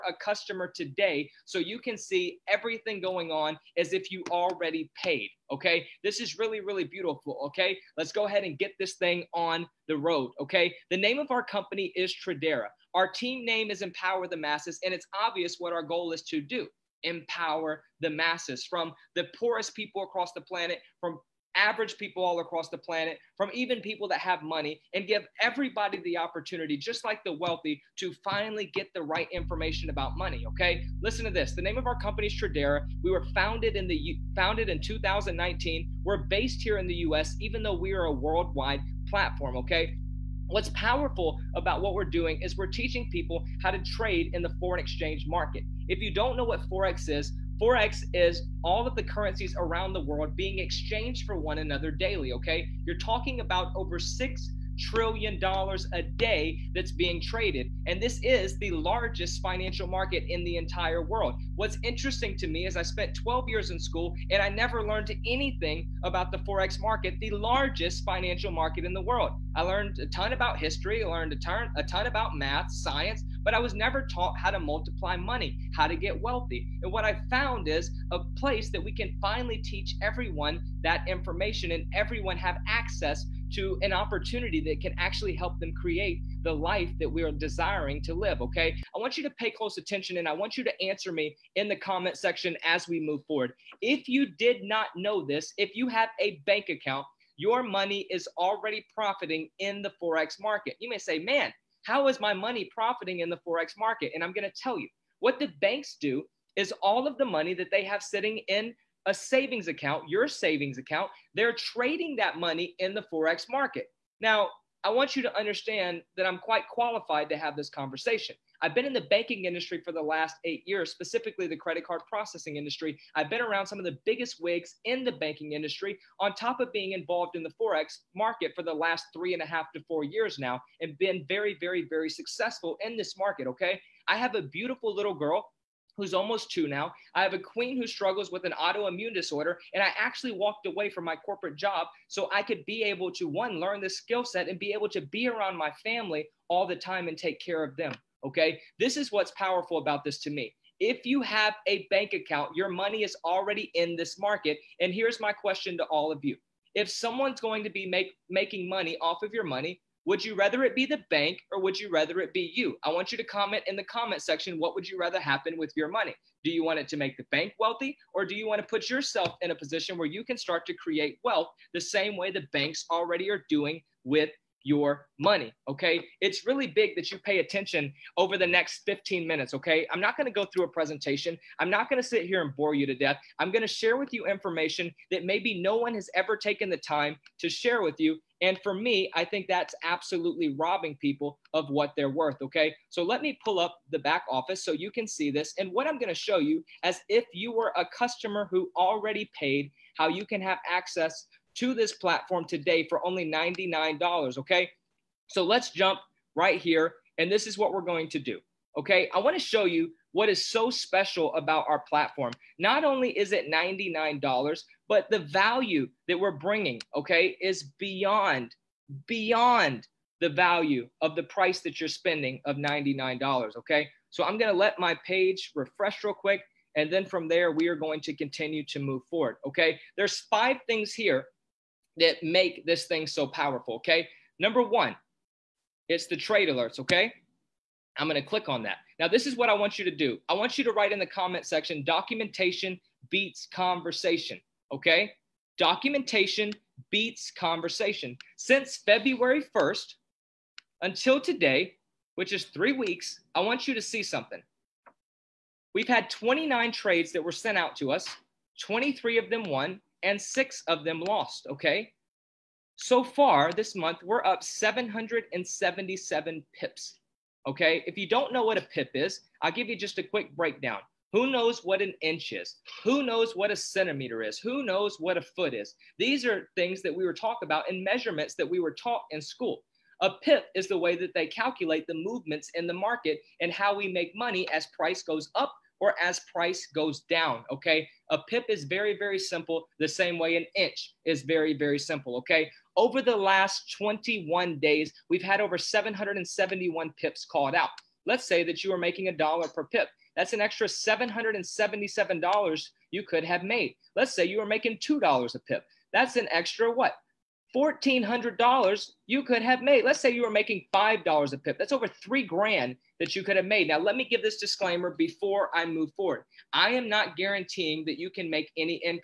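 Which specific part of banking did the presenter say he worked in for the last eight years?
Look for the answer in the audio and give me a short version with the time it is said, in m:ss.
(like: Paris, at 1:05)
credit card processing, at 2:01.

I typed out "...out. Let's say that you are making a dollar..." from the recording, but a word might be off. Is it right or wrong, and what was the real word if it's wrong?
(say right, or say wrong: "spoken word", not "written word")
right.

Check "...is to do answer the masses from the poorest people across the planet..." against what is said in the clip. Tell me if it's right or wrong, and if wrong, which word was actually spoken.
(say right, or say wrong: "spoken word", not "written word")
wrong: "empower", not "answer".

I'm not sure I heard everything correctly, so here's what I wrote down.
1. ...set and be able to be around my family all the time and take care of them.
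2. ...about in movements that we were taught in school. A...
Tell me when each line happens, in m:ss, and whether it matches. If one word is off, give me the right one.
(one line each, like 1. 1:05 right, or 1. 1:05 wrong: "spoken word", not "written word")
1. 2:24 right
2. 4:37 wrong: "measurements", not "movements".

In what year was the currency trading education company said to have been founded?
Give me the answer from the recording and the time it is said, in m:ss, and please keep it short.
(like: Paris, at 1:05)
2019, at 0:34.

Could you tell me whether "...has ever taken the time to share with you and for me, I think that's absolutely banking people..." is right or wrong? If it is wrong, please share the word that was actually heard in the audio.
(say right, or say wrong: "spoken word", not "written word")
wrong: "robbing", not "banking".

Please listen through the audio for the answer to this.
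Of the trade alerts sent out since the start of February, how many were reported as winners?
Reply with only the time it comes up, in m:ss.
4:18.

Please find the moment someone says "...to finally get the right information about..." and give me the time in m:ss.
0:27.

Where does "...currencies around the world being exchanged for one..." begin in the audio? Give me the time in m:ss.
0:49.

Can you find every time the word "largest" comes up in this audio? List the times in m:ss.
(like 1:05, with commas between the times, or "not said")
0:58, 1:07.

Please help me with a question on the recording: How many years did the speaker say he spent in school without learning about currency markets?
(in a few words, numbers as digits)
12.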